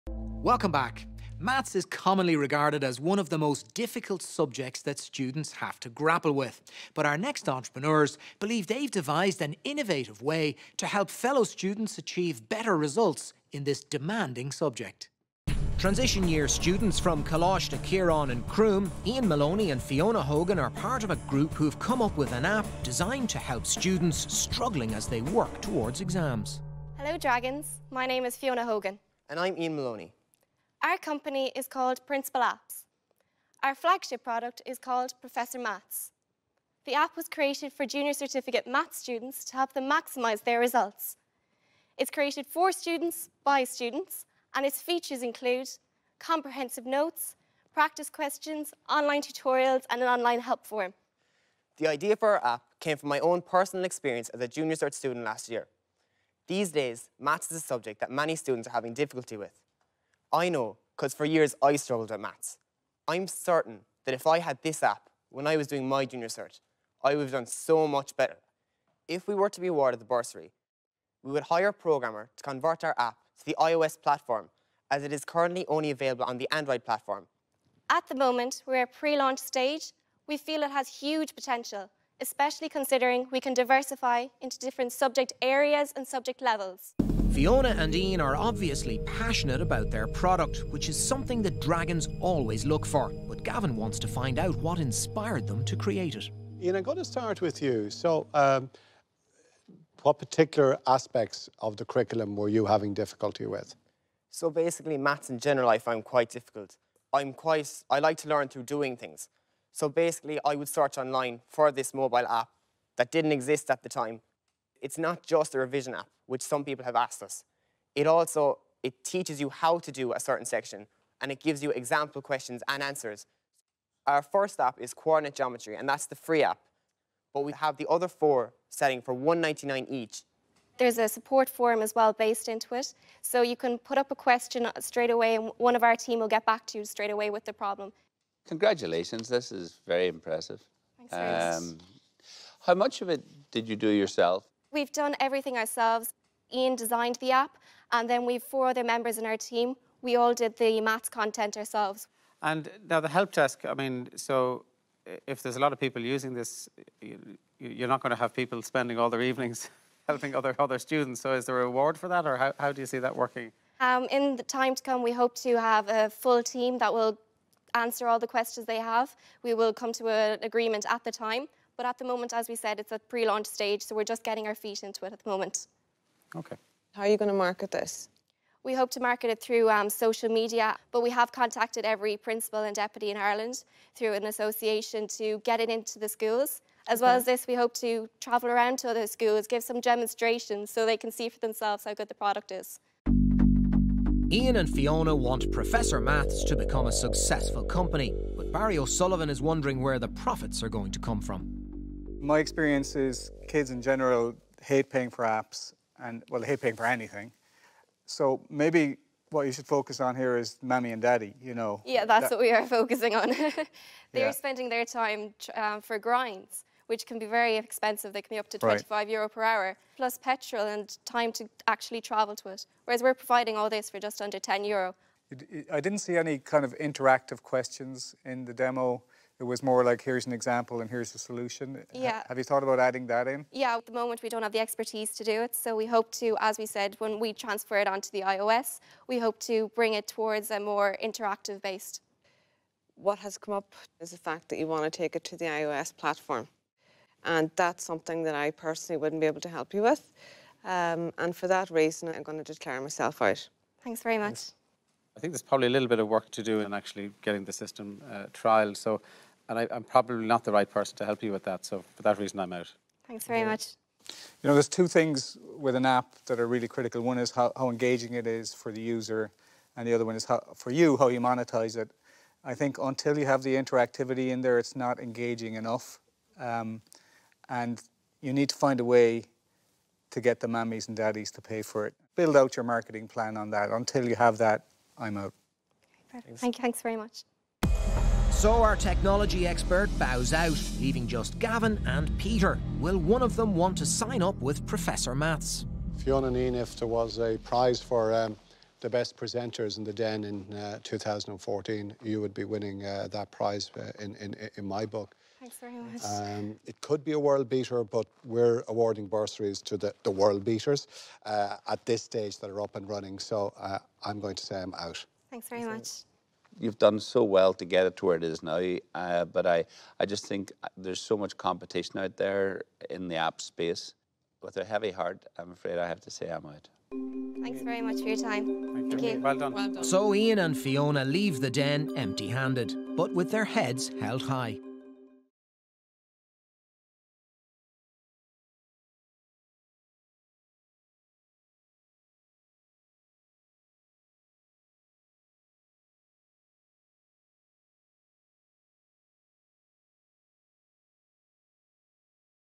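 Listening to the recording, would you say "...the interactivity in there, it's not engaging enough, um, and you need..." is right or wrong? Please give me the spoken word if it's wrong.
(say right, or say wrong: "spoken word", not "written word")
right.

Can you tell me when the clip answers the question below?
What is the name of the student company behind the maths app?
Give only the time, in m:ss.
0:32.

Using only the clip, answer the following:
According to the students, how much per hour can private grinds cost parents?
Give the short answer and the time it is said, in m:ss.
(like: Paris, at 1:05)
25 euro, at 3:38.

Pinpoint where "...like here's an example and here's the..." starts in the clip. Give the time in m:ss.
3:49.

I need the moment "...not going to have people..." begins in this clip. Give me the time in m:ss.
2:37.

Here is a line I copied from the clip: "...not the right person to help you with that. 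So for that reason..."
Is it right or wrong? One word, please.
right.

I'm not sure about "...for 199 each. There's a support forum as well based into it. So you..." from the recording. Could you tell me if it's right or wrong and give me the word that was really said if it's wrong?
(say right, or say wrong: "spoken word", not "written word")
right.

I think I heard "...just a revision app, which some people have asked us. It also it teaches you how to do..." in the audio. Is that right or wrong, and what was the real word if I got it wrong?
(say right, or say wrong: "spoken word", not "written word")
right.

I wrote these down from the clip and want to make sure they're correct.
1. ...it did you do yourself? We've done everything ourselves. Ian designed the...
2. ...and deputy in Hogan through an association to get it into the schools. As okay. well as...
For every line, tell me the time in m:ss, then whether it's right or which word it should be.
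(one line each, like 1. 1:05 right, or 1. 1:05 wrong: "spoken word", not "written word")
1. 2:23 right
2. 3:02 wrong: "Ireland", not "Hogan".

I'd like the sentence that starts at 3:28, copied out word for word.
So maybe what you should focus on here is mommy and daddy, you know.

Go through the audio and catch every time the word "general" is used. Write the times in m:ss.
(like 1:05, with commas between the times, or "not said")
1:45, 3:23.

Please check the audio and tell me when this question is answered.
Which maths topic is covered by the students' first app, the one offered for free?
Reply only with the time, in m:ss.
2:04.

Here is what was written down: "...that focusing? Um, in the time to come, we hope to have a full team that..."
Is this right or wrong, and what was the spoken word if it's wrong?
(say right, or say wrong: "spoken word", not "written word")
wrong: "working", not "focusing".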